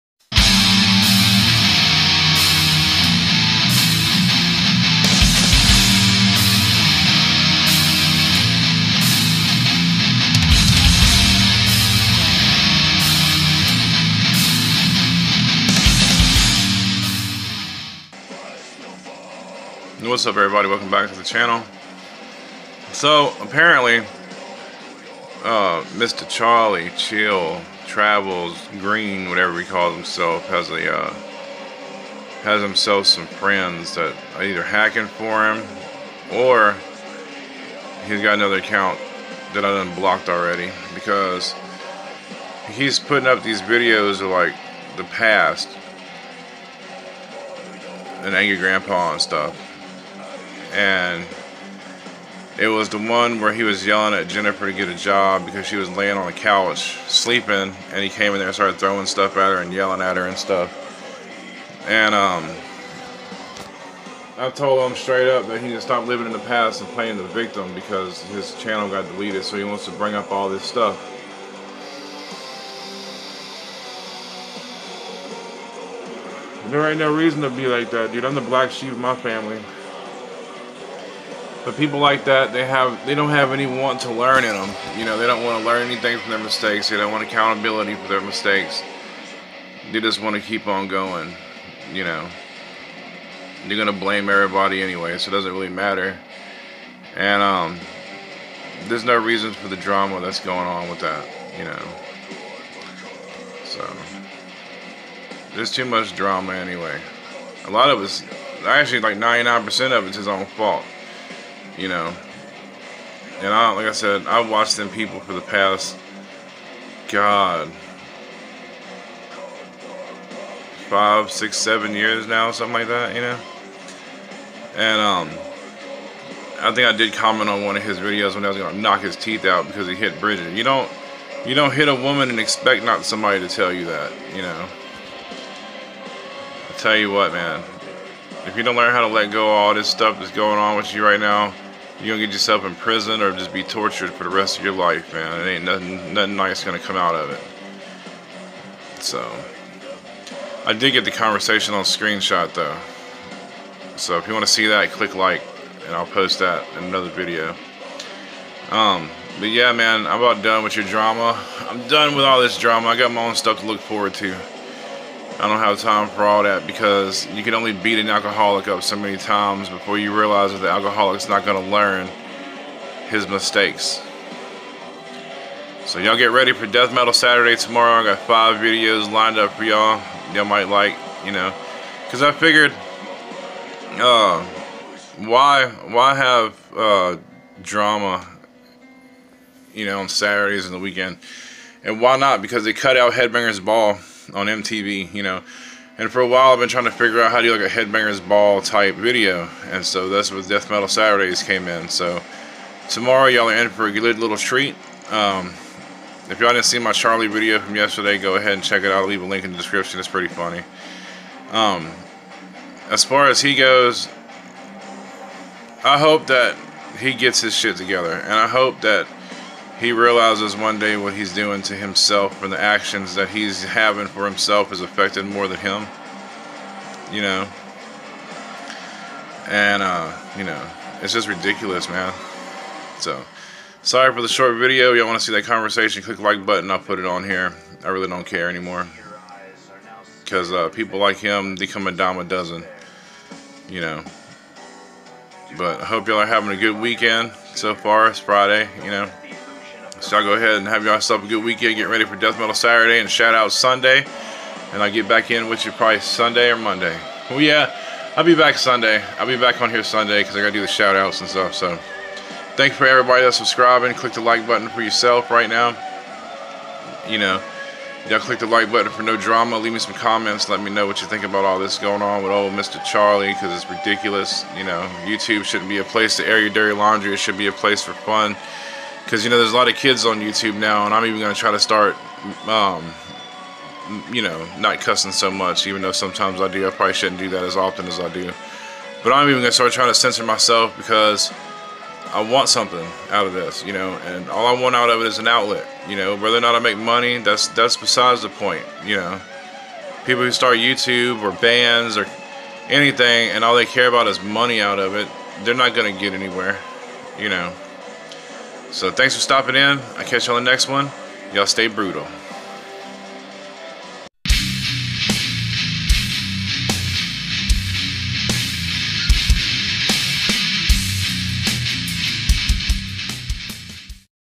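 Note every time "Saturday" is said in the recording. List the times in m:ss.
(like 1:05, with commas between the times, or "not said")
2:57, 3:10, 3:20, 4:12.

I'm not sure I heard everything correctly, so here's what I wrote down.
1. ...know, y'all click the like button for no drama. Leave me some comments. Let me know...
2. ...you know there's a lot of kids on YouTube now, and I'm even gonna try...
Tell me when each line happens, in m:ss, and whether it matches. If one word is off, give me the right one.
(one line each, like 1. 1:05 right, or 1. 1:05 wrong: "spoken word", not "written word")
1. 4:27 right
2. 4:39 right.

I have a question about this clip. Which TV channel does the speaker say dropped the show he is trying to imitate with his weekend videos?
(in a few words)
MTV.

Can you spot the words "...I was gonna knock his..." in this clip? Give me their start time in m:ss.
2:08.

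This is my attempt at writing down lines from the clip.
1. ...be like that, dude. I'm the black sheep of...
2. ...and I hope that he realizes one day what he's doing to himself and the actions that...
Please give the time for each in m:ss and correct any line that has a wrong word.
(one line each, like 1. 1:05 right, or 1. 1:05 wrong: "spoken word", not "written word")
1. 1:17 right
2. 3:38 right.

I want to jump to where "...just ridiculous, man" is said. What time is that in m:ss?
3:51.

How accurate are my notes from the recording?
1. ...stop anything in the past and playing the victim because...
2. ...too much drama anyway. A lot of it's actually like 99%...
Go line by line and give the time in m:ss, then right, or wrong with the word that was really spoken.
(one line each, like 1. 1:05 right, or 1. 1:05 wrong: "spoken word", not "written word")
1. 1:05 wrong: "living", not "anything"
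2. 1:45 right.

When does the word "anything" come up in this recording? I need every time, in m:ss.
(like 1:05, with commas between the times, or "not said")
1:25, 5:02.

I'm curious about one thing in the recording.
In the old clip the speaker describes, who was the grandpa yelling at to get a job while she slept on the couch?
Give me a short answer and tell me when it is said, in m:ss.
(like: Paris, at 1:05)
Jennifer, at 0:54.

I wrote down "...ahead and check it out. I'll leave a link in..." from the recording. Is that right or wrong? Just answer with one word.
right.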